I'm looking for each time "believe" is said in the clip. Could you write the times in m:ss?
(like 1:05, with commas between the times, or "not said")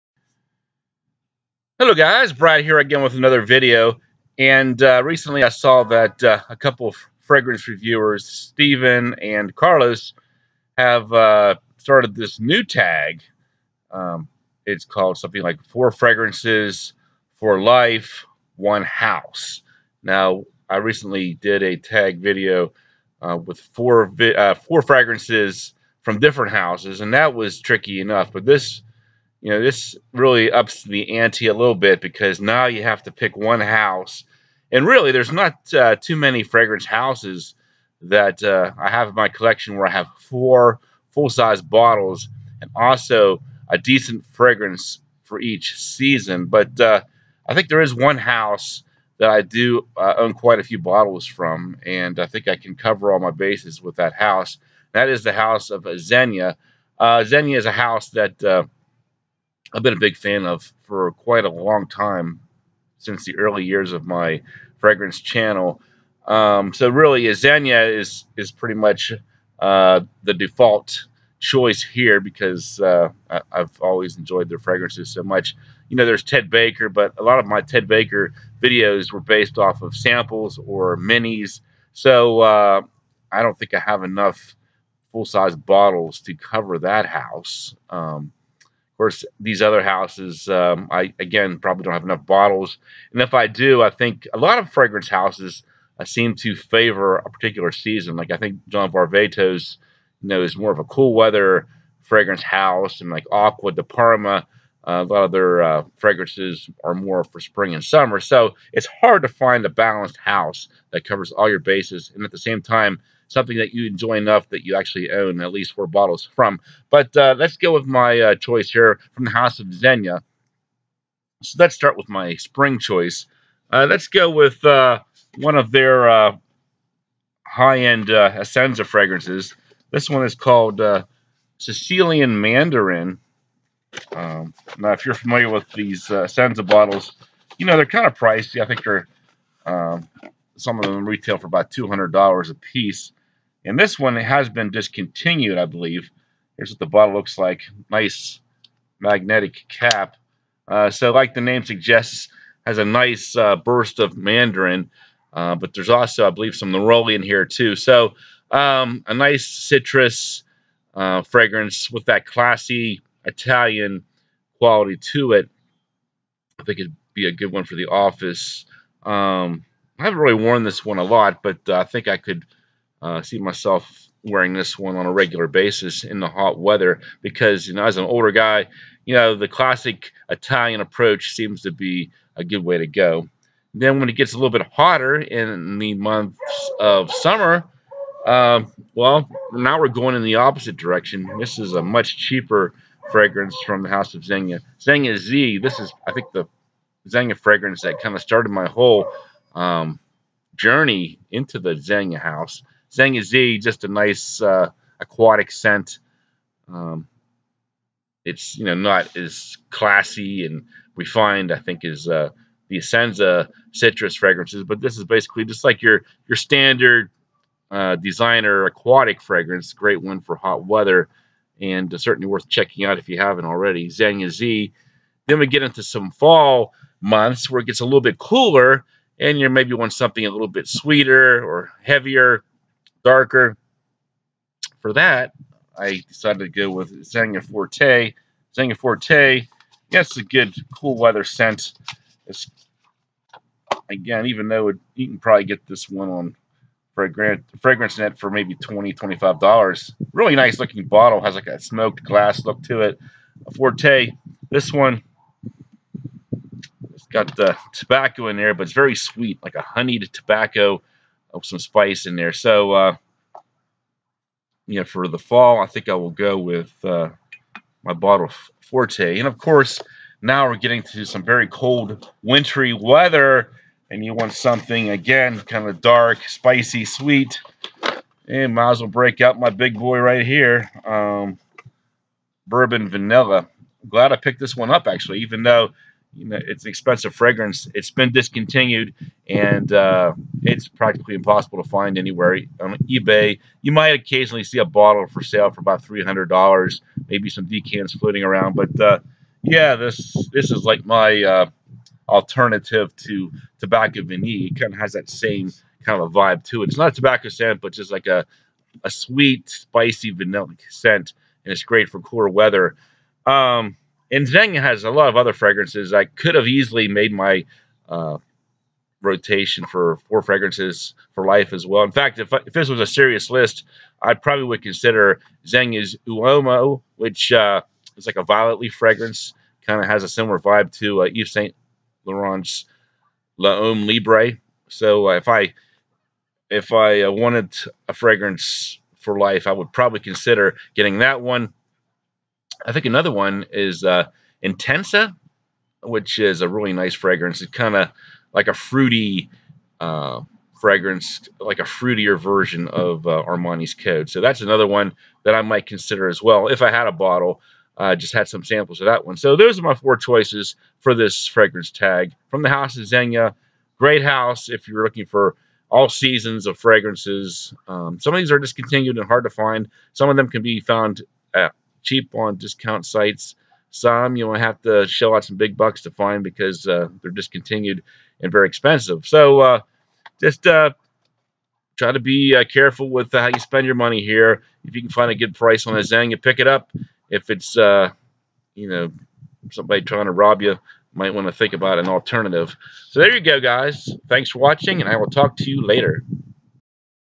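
2:25, 2:36.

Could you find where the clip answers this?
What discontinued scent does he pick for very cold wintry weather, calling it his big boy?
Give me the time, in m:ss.
4:42.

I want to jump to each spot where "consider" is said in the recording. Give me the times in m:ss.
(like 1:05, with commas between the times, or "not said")
5:24, 5:40, 5:55.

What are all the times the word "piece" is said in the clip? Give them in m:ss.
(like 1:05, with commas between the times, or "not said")
2:22.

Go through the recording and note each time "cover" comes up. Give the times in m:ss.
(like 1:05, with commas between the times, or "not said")
0:52, 1:26, 1:51.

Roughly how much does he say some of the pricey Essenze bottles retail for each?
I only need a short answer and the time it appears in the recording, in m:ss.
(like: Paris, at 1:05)
$200, at 2:21.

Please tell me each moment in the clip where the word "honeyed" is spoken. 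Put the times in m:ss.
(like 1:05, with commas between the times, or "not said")
4:19.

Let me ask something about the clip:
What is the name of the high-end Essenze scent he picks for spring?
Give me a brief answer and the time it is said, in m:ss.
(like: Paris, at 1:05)
Sicilian Mandarin, at 2:11.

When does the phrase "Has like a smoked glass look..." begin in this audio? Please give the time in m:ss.
4:11.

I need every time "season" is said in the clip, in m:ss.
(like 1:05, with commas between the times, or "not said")
0:45, 1:37, 6:05.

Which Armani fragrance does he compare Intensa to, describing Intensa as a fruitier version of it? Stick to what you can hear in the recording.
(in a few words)
Armani Code.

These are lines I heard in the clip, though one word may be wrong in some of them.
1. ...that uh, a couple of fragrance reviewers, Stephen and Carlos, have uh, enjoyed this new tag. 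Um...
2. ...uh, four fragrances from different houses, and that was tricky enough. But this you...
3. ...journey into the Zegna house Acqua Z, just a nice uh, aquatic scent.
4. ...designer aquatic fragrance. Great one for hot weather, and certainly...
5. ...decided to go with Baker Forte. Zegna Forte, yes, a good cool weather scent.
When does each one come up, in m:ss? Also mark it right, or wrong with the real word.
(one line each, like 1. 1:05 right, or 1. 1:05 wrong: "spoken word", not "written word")
1. 0:05 wrong: "started", not "enjoyed"
2. 0:24 right
3. 3:20 wrong: "Zegna", not "Acqua"
4. 3:37 right
5. 3:56 wrong: "Zegna", not "Baker".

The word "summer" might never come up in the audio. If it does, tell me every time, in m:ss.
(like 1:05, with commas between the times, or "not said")
1:47, 3:07.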